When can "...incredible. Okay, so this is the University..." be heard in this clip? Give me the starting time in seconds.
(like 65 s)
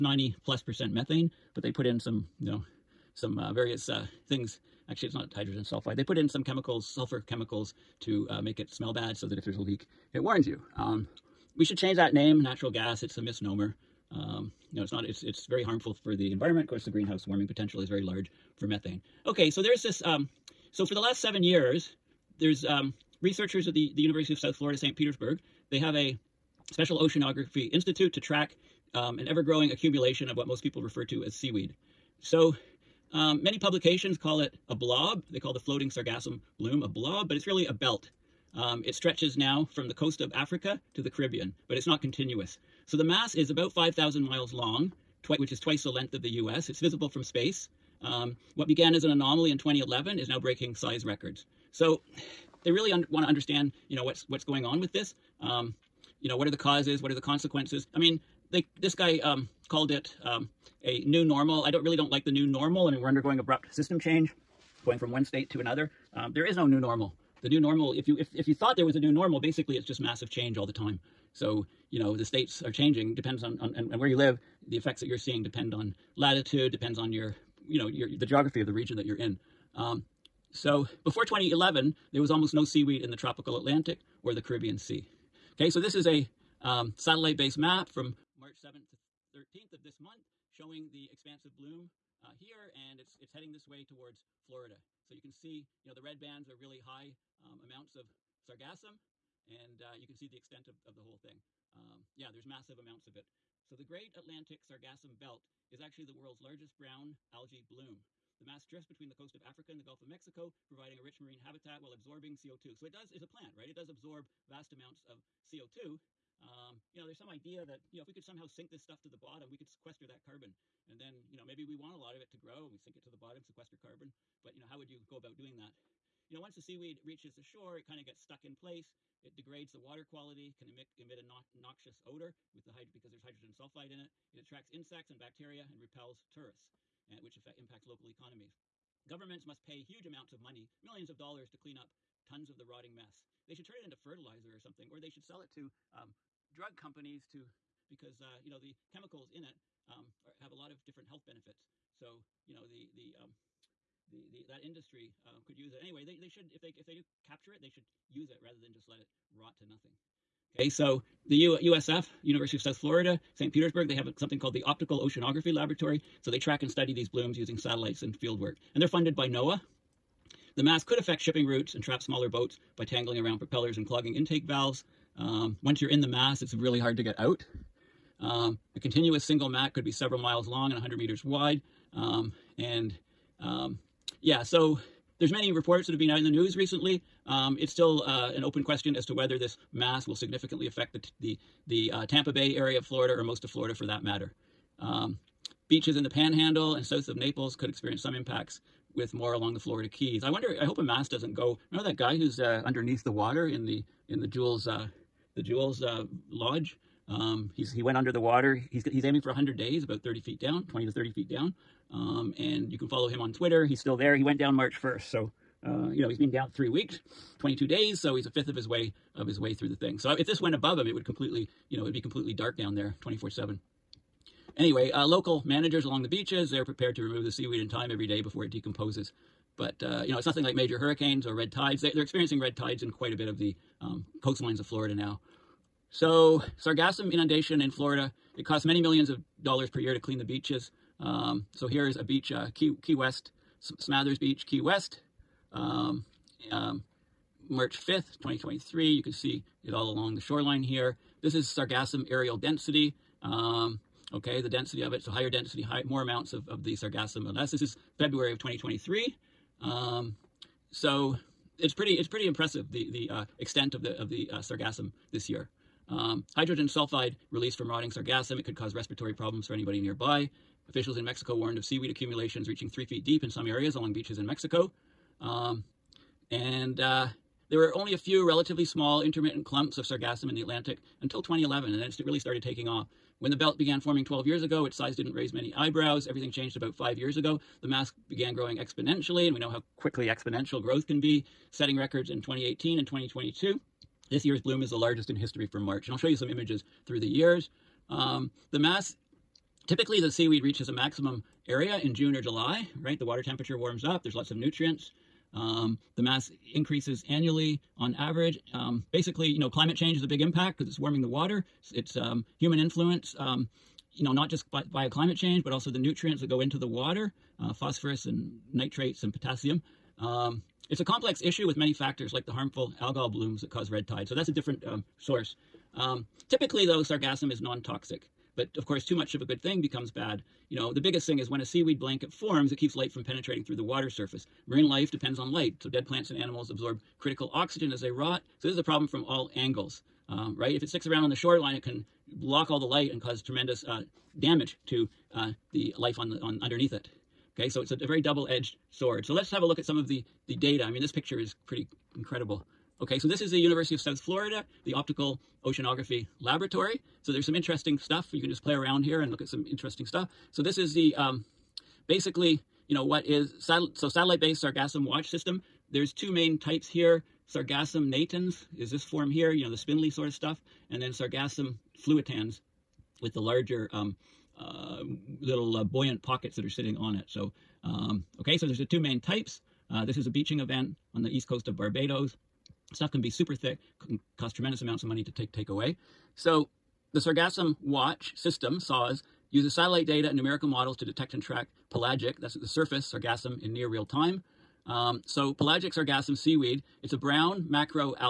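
351 s.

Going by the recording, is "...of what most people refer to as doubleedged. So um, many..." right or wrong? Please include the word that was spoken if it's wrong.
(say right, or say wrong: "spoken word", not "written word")
wrong: "seaweed", not "doubleedged".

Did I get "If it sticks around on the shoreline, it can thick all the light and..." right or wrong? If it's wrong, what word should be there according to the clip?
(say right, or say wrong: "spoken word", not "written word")
wrong: "block", not "thick".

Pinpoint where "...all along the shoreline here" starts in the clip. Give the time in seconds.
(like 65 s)
249 s.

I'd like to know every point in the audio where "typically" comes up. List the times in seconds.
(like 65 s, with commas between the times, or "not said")
299 s, 326 s.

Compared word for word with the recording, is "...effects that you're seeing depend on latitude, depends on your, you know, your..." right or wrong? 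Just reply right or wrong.
right.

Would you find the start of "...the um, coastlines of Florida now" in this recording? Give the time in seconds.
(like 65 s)
233 s.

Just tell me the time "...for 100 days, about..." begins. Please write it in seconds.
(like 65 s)
209 s.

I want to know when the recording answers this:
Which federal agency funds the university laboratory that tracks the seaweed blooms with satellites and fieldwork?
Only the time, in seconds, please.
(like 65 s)
169 s.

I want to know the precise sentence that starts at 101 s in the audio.
Um, yeah, there's massive amounts of it.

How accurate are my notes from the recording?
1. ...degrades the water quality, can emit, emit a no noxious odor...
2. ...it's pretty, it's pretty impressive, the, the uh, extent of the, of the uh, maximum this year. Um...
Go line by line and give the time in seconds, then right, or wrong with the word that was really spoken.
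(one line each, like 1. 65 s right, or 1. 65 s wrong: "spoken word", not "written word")
1. 129 s right
2. 261 s wrong: "sargassum", not "maximum".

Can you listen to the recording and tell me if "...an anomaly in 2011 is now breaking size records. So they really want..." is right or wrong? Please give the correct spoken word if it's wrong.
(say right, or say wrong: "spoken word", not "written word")
right.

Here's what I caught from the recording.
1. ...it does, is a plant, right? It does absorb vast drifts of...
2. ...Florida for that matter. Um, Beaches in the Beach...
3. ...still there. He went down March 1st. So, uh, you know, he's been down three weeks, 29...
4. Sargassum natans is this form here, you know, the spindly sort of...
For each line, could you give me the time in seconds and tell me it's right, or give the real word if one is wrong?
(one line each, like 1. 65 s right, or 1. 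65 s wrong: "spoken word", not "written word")
1. 112 s wrong: "amounts", not "drifts"
2. 193 s wrong: "Panhandle", not "Beach"
3. 213 s wrong: "22", not "29"
4. 367 s right.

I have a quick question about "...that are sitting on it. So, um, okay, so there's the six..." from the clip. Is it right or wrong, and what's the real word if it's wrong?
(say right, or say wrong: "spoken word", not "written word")
wrong: "two", not "six".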